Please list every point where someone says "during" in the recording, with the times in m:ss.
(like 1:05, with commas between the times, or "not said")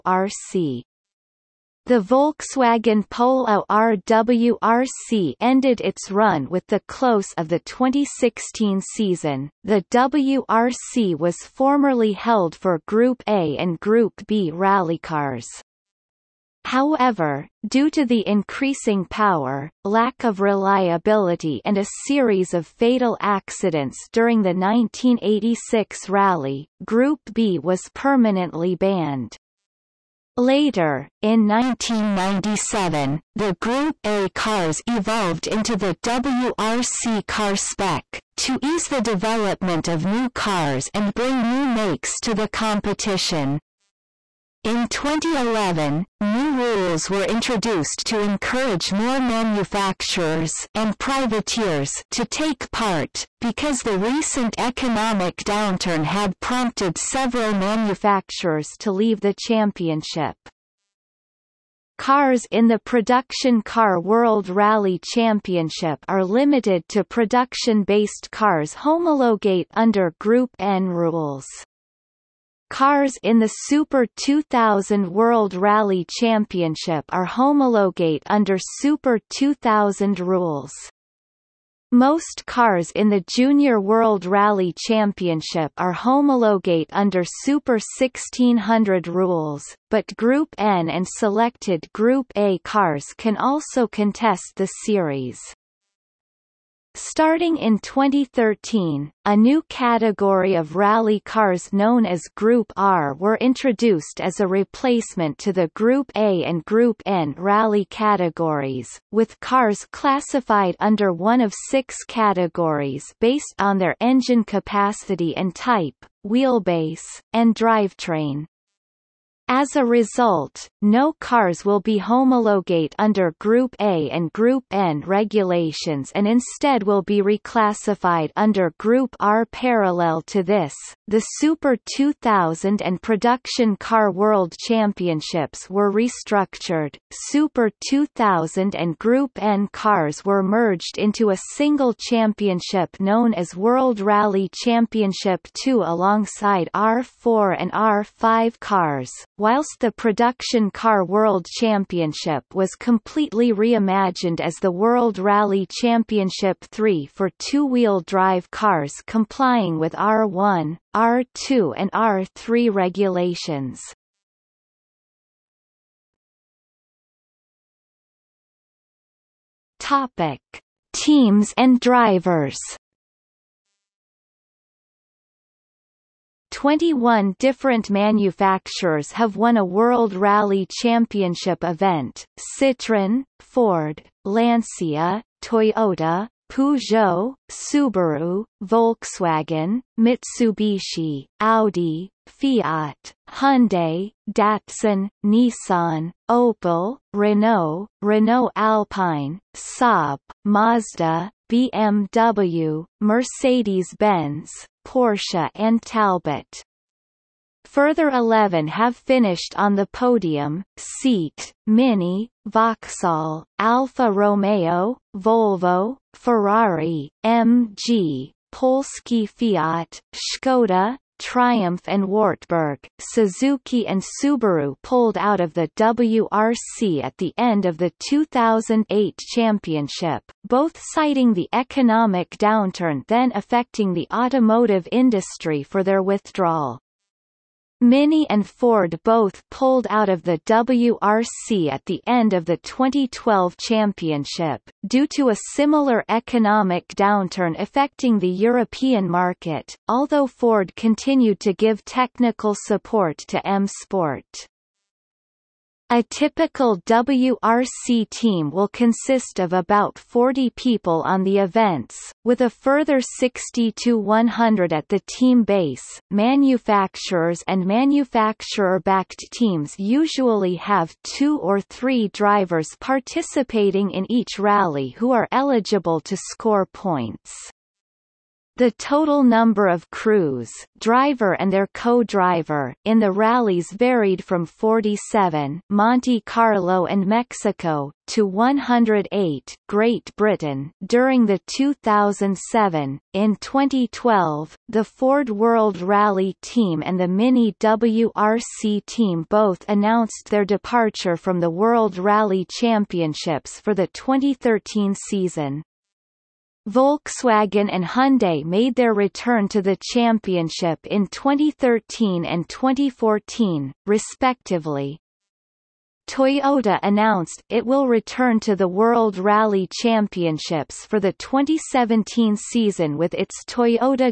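0:24, 4:50.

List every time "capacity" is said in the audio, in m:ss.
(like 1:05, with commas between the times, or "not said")
1:54.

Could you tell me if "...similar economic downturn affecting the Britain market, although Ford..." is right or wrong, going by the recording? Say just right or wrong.
wrong.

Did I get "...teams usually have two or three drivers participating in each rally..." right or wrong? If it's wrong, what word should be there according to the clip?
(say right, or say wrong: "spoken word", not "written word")
right.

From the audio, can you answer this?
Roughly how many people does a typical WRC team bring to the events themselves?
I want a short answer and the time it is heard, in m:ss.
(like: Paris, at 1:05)
About 40, at 4:19.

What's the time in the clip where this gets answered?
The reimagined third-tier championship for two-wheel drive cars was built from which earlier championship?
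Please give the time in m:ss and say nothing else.
2:29.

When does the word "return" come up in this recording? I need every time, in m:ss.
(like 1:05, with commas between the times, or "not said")
5:08, 5:17.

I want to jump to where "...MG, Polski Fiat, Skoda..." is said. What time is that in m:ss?
3:37.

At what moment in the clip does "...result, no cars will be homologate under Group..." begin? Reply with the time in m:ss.
1:59.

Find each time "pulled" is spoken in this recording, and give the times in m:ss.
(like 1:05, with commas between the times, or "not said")
3:44, 3:59.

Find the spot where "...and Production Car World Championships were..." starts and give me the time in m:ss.
2:12.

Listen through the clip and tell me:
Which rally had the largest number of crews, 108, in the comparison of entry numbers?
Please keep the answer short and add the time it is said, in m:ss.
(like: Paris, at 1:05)
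Great Britain, at 4:49.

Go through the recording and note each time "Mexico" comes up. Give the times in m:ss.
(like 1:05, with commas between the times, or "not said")
4:47.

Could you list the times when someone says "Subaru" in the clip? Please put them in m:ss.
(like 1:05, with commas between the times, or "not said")
3:07, 3:44.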